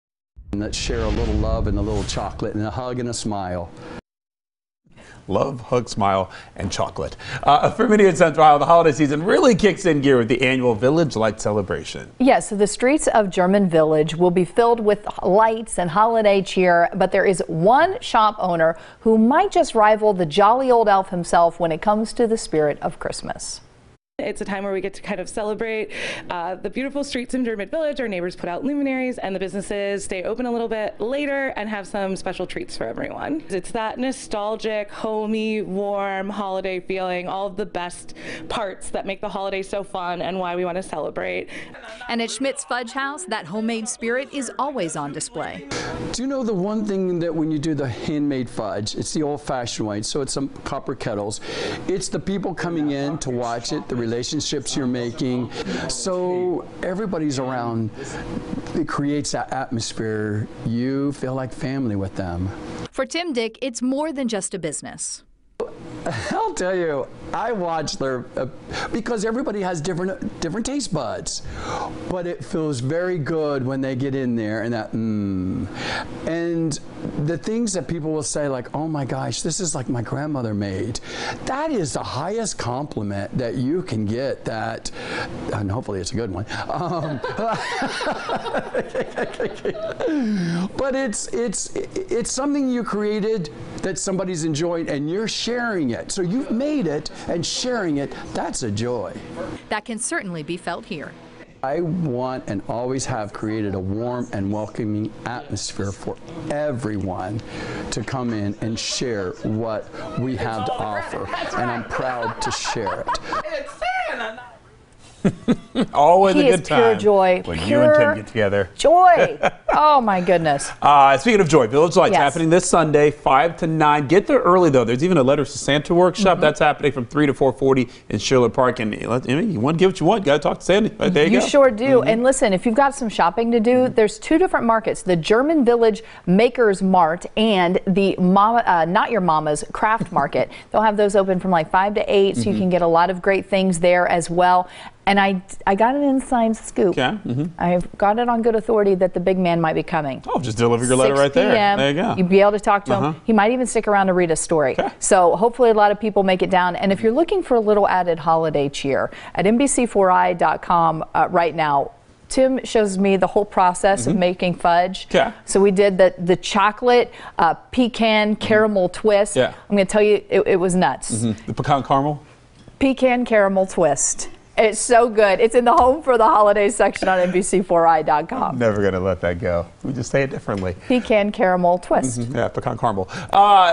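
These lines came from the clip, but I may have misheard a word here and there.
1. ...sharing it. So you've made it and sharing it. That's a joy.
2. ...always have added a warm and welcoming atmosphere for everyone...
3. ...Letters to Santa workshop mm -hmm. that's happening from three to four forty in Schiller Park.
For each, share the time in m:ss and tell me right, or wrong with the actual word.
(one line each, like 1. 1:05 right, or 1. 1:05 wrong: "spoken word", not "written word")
1. 1:35 right
2. 1:42 wrong: "created", not "added"
3. 2:05 right.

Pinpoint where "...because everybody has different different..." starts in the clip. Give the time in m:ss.
1:08.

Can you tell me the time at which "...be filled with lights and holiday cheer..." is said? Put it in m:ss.
0:14.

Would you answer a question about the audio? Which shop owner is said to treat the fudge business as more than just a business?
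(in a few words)
Tim Dick.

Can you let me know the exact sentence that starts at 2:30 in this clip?
Oh, just deliver your letter right there.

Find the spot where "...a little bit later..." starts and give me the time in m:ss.
0:30.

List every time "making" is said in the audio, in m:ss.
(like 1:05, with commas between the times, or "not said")
0:55, 2:44.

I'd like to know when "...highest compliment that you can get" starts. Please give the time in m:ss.
1:22.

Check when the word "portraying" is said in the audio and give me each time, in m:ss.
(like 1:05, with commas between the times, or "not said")
not said.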